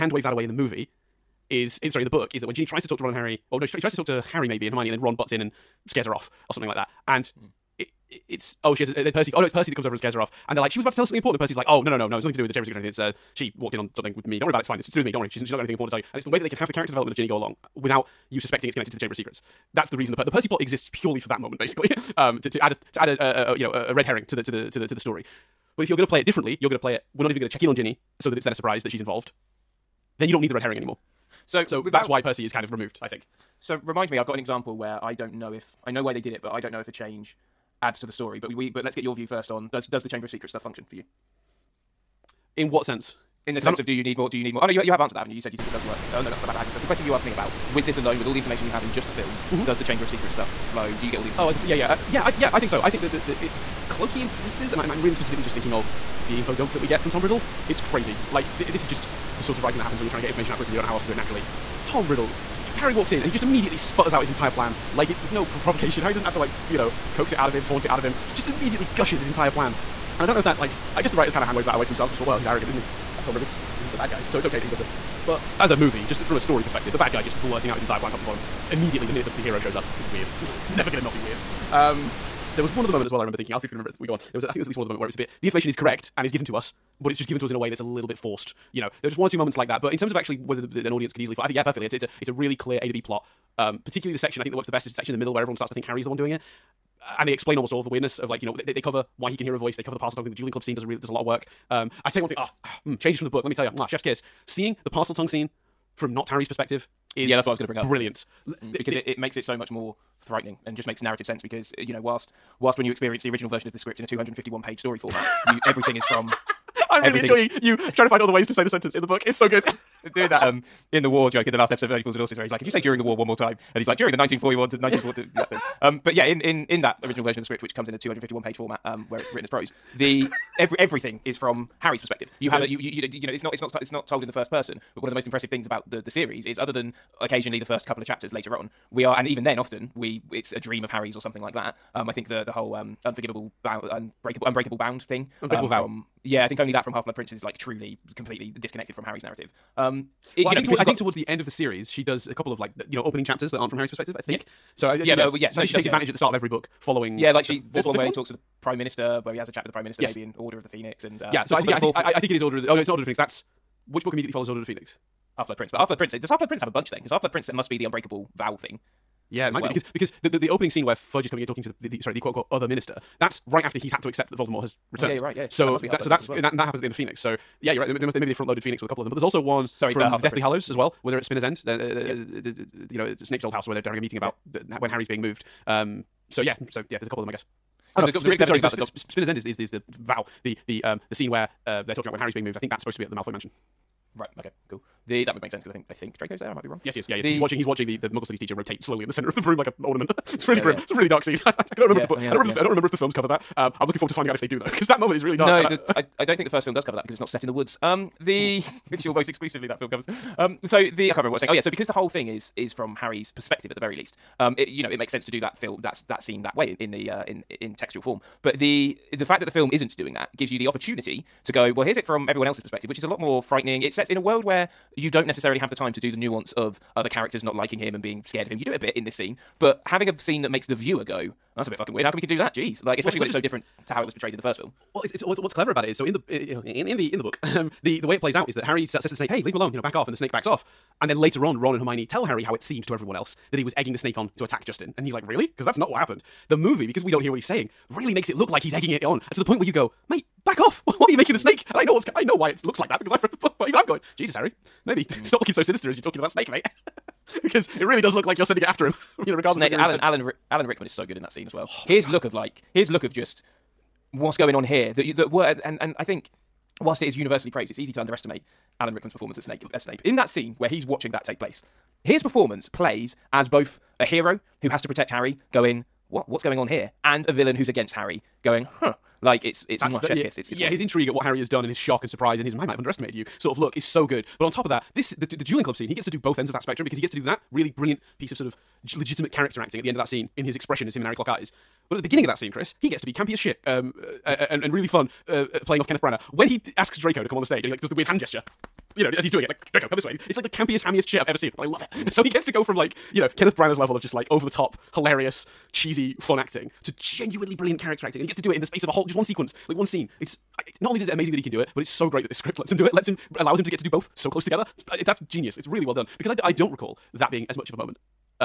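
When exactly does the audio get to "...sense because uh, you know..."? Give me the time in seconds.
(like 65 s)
111 s.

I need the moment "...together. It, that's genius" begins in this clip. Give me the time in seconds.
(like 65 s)
314 s.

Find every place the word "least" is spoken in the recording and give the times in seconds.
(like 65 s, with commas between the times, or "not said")
84 s, 213 s.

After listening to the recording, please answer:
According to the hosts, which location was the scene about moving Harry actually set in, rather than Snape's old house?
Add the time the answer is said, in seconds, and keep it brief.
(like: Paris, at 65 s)
Malfoy mansion, at 193 s.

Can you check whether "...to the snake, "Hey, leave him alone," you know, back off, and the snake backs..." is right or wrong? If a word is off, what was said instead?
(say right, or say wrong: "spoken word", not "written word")
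right.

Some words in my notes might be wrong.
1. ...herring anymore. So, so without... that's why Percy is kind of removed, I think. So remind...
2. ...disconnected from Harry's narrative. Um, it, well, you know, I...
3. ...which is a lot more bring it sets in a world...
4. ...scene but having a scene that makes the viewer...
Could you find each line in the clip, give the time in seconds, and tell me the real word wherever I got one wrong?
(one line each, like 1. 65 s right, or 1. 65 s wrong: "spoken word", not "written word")
1. 30 s right
2. 148 s right
3. 222 s wrong: "frightening", not "bring"
4. 229 s right.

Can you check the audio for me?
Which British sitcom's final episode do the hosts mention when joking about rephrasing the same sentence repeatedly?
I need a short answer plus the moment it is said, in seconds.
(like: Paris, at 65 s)
Only Fools and Horses, at 121 s.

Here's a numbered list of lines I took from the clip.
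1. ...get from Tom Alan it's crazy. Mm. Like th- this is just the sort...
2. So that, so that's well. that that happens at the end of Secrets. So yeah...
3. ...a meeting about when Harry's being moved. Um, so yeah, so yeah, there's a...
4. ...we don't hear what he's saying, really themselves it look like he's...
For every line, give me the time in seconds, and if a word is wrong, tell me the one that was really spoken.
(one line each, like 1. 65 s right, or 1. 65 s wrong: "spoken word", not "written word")
1. 56 s wrong: "Riddle", not "Alan"
2. 175 s wrong: "Phoenix", not "Secrets"
3. 183 s right
4. 247 s wrong: "makes", not "themselves".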